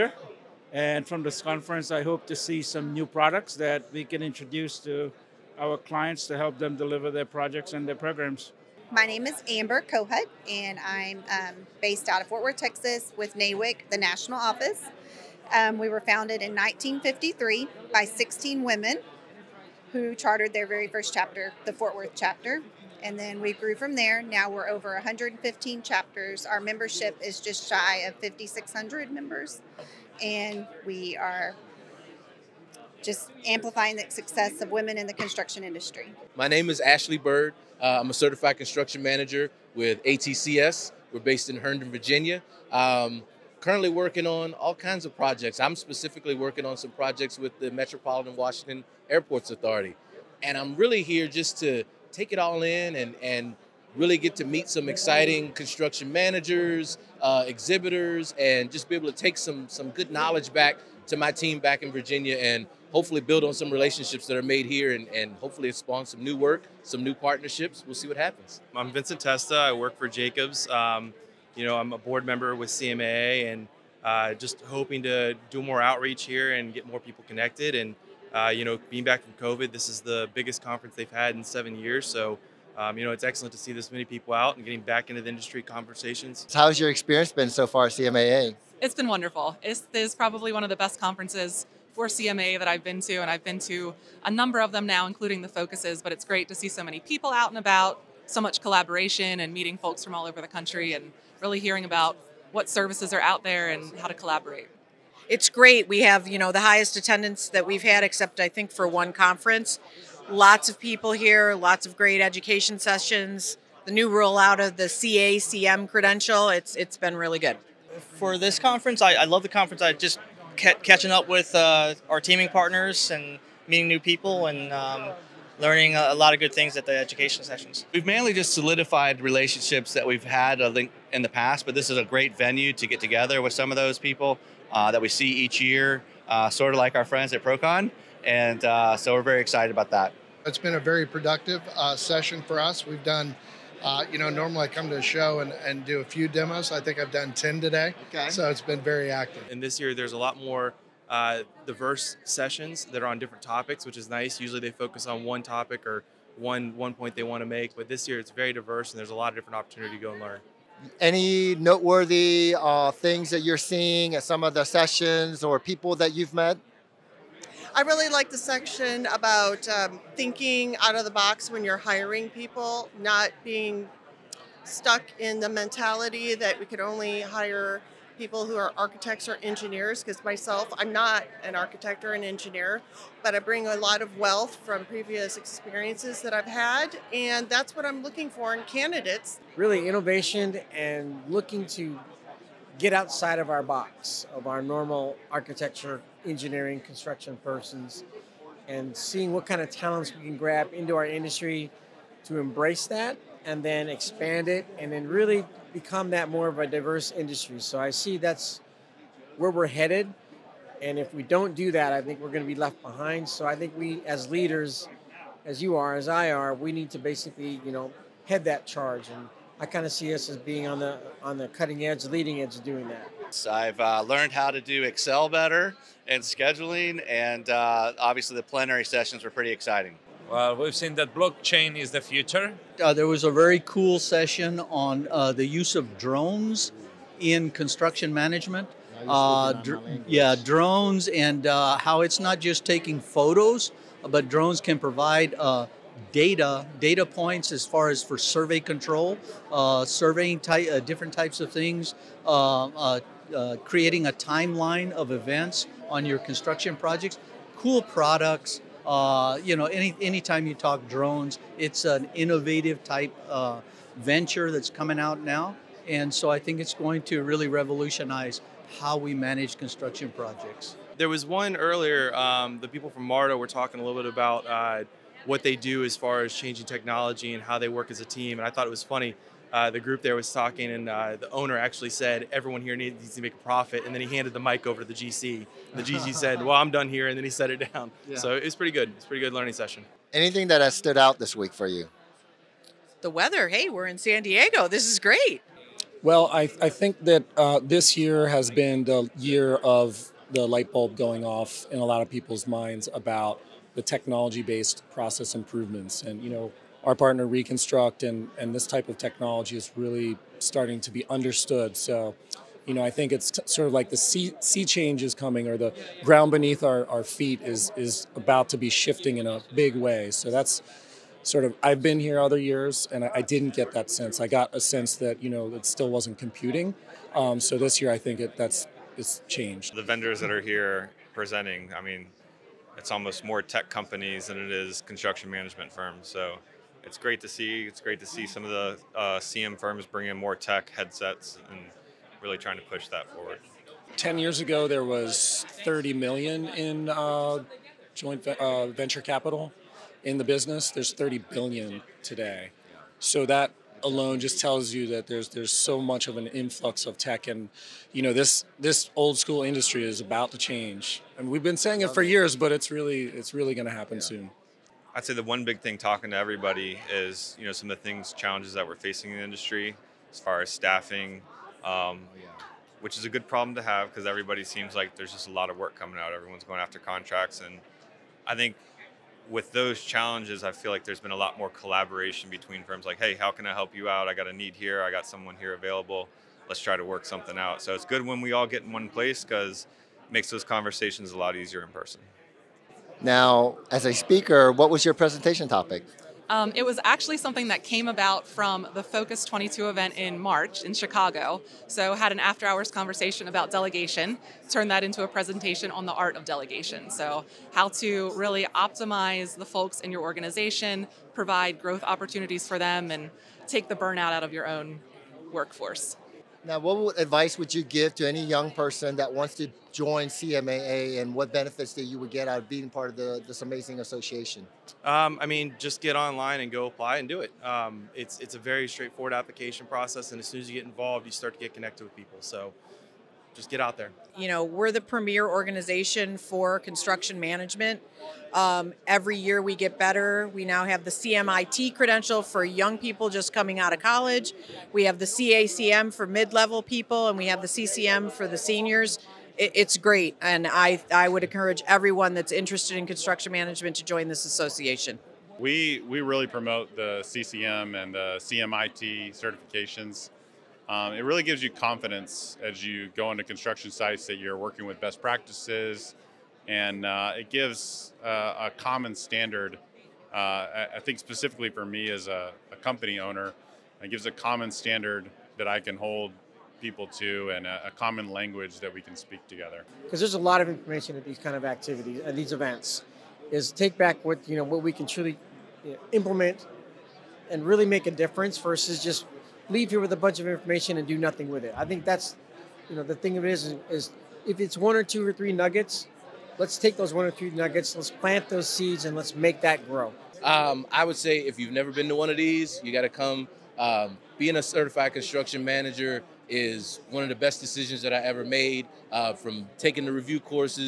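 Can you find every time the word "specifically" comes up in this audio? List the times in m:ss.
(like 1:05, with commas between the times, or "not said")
0:45, 7:50.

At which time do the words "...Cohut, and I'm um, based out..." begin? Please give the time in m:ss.
0:09.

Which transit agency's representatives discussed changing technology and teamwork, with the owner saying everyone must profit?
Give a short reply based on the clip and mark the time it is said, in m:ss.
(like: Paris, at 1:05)
MARTA, at 4:33.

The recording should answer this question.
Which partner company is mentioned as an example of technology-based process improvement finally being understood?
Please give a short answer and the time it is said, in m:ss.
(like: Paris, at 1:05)
Reconstruct, at 5:07.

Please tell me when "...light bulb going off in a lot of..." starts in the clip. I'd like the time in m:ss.
5:00.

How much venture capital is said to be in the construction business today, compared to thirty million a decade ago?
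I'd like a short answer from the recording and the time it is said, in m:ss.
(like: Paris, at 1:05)
30 billion, at 5:50.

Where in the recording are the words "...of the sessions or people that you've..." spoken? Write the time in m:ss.
2:44.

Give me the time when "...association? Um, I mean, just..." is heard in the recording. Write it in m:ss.
7:03.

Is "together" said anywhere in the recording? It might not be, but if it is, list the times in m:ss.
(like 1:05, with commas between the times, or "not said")
2:12, 7:59.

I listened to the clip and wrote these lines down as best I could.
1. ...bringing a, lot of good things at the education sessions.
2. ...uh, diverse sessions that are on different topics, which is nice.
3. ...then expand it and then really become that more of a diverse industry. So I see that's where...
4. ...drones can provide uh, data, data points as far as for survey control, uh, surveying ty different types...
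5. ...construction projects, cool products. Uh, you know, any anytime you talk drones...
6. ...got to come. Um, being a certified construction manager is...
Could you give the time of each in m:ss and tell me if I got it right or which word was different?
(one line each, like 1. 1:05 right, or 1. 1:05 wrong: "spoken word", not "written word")
1. 2:05 wrong: "learning", not "bringing"
2. 2:31 right
3. 3:23 right
4. 4:04 right
5. 4:16 right
6. 8:22 right.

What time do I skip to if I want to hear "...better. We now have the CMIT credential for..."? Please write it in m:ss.
7:19.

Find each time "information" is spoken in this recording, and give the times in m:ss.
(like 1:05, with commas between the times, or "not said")
8:00, 8:10.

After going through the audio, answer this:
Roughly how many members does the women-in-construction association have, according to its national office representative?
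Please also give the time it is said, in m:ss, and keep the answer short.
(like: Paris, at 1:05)
5,600, at 0:28.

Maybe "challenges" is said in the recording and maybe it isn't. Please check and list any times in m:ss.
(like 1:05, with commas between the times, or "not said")
6:08, 6:19.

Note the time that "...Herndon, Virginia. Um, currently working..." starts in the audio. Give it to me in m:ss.
0:41.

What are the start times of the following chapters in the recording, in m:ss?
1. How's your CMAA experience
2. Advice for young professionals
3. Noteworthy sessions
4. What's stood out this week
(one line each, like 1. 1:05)
1. 1:25
2. 6:55
3. 2:40
4. 4:49.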